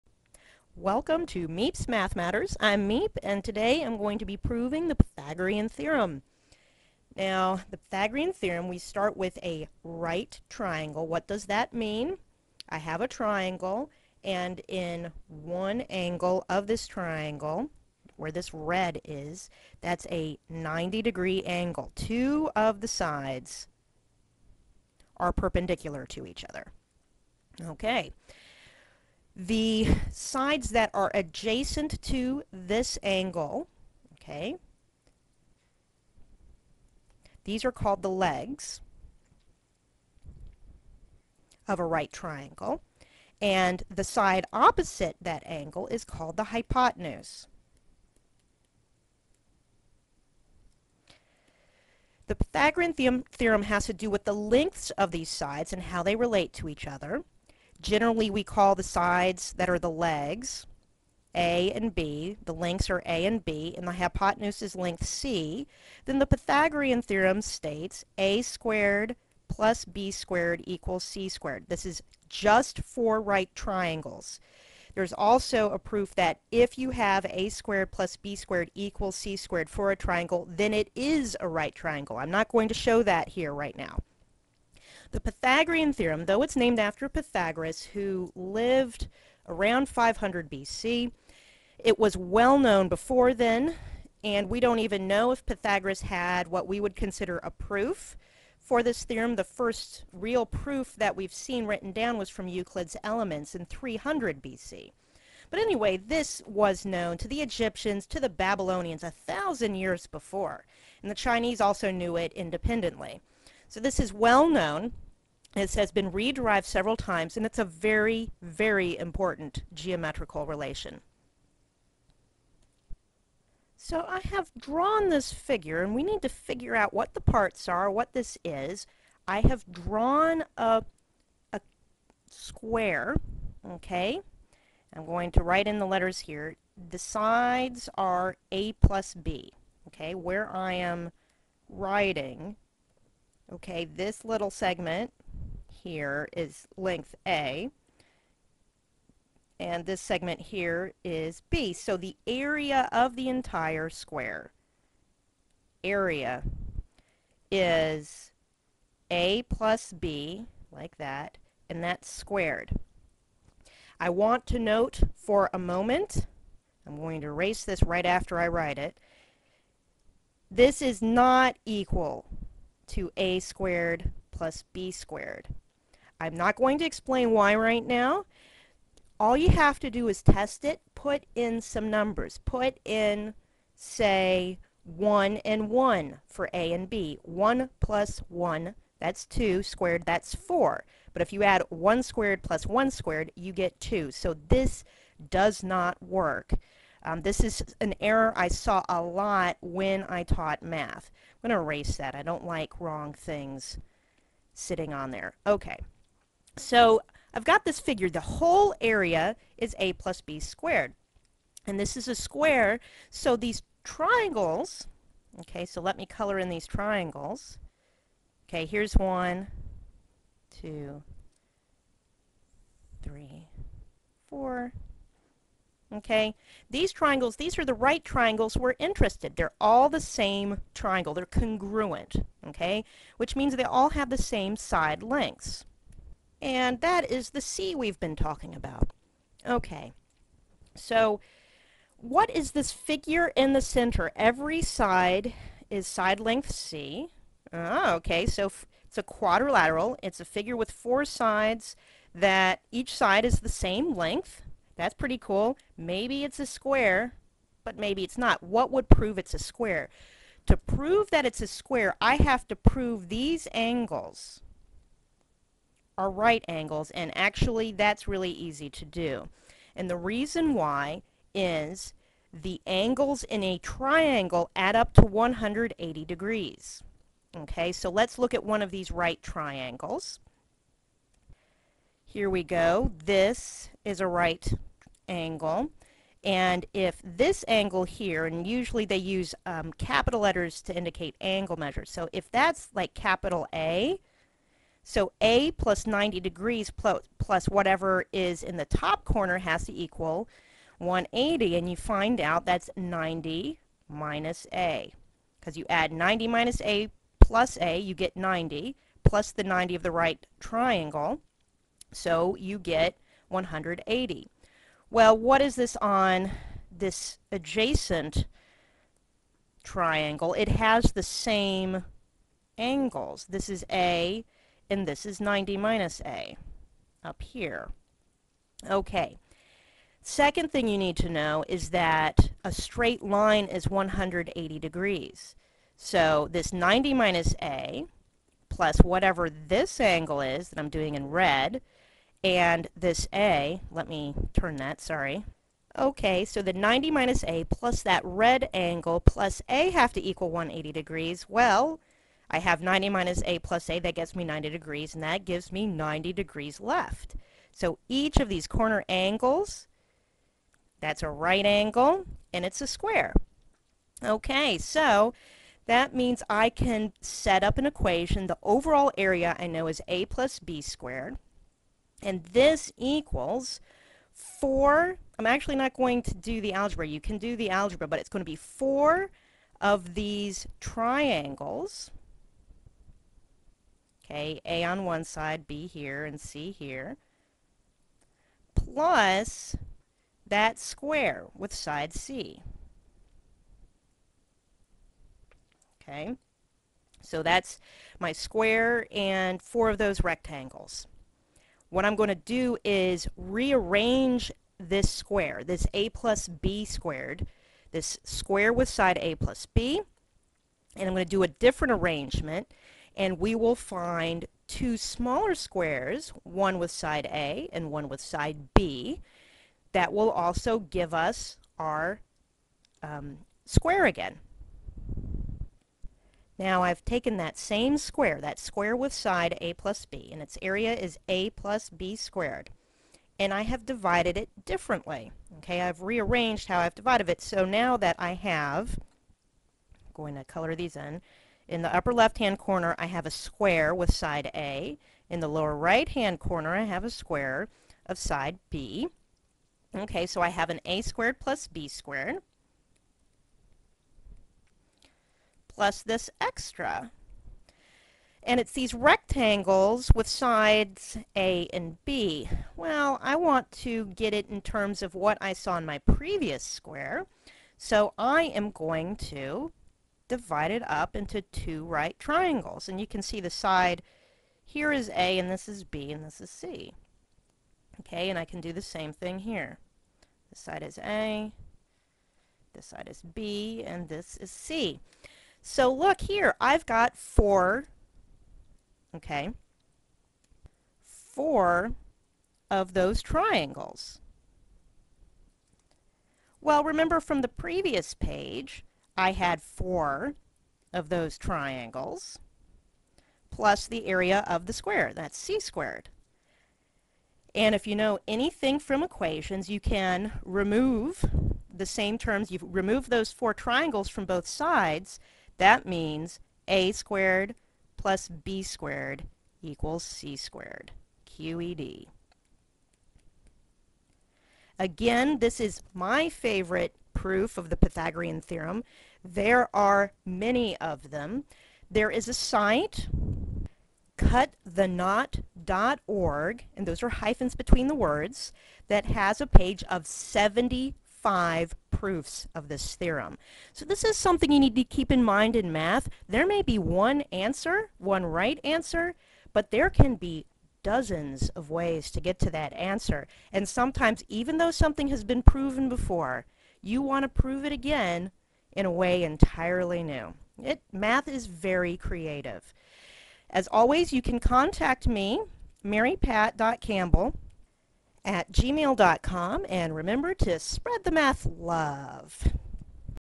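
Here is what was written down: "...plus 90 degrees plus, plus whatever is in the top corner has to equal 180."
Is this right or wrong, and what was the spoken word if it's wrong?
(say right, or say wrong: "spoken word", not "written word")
right.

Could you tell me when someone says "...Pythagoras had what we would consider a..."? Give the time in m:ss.
1:35.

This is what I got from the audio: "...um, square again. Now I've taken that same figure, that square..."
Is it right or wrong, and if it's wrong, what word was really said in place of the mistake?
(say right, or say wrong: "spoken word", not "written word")
wrong: "square", not "figure".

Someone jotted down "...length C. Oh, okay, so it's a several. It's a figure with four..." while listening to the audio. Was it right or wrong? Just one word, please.
wrong.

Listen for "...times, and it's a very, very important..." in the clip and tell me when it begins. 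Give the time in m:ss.
1:56.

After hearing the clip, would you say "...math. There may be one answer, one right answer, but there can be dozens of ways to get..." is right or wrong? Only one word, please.
right.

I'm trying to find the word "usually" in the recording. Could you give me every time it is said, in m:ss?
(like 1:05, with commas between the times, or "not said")
4:48.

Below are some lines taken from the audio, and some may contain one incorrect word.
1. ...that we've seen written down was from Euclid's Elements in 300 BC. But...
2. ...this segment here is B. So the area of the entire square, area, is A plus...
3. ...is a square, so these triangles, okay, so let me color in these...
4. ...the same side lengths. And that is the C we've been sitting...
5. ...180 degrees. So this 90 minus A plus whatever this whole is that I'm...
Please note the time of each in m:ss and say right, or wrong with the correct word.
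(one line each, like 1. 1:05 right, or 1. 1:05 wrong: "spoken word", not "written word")
1. 1:40 right
2. 2:29 right
3. 3:31 right
4. 3:54 wrong: "talking", not "sitting"
5. 5:33 wrong: "angle", not "whole".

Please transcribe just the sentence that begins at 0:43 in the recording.
And the side opposite that angle is called the hypotenuse.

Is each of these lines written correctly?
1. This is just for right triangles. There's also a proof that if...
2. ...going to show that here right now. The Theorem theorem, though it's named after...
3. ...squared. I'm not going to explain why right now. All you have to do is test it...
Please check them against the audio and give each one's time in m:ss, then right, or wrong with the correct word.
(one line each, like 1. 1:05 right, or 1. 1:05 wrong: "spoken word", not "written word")
1. 1:11 right
2. 1:22 wrong: "Pythagorean", not "Theorem"
3. 2:54 right.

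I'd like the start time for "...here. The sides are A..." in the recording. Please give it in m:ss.
2:16.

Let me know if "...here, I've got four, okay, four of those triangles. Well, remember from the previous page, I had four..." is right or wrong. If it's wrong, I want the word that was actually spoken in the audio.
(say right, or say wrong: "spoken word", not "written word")
right.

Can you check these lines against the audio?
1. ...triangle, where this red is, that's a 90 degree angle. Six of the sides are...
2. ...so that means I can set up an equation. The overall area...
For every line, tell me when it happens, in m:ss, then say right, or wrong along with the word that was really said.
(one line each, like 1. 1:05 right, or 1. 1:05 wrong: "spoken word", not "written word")
1. 0:16 wrong: "Two", not "Six"
2. 6:04 right.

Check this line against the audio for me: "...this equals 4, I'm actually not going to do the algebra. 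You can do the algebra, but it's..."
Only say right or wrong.
right.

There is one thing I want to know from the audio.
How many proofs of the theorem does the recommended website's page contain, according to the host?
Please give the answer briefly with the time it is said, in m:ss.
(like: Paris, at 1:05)
75, at 8:59.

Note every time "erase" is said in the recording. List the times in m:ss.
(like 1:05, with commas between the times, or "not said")
2:47, 3:21.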